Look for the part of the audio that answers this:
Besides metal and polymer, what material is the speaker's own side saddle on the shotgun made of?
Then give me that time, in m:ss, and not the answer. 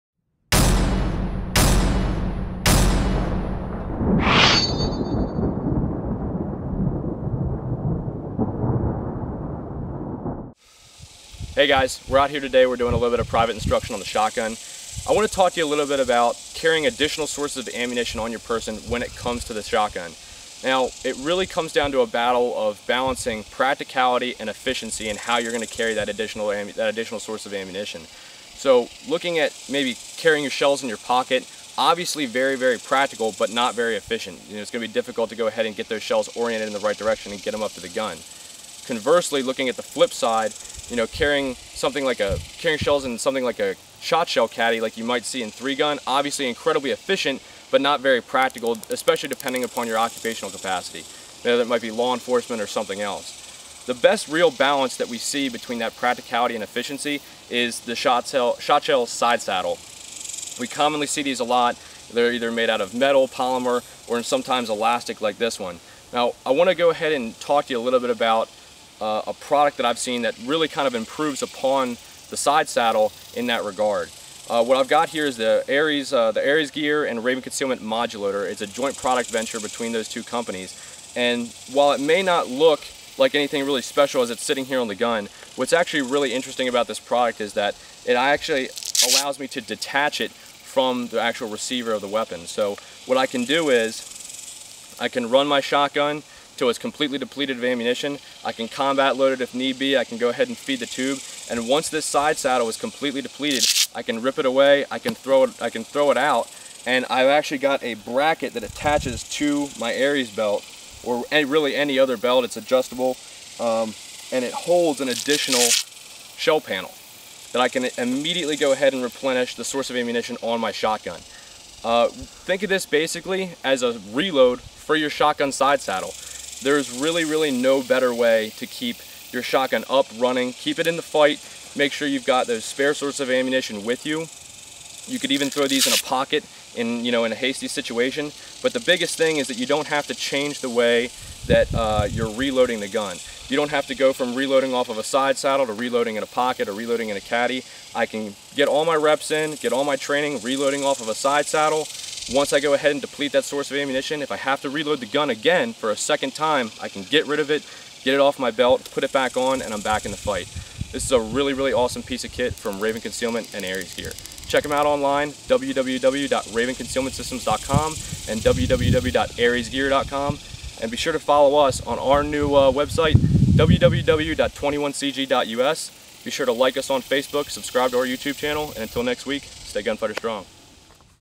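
1:04.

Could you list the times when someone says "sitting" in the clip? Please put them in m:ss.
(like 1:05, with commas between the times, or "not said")
1:24.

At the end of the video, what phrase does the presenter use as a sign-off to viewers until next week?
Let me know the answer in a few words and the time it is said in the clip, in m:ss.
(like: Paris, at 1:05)
stay gunfighter strong, at 2:59.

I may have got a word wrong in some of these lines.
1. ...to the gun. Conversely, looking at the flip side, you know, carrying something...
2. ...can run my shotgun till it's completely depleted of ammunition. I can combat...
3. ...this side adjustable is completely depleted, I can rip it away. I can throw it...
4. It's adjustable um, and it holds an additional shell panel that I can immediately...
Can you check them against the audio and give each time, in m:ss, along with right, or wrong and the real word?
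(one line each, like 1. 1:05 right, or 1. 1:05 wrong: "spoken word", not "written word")
1. 0:37 right
2. 1:35 right
3. 1:41 wrong: "saddle", not "adjustable"
4. 1:52 right.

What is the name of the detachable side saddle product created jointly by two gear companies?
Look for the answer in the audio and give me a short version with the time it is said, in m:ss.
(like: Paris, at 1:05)
Moduloader, at 1:17.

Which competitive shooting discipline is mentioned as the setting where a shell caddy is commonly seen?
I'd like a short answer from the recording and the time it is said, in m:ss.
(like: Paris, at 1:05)
three gun, at 0:45.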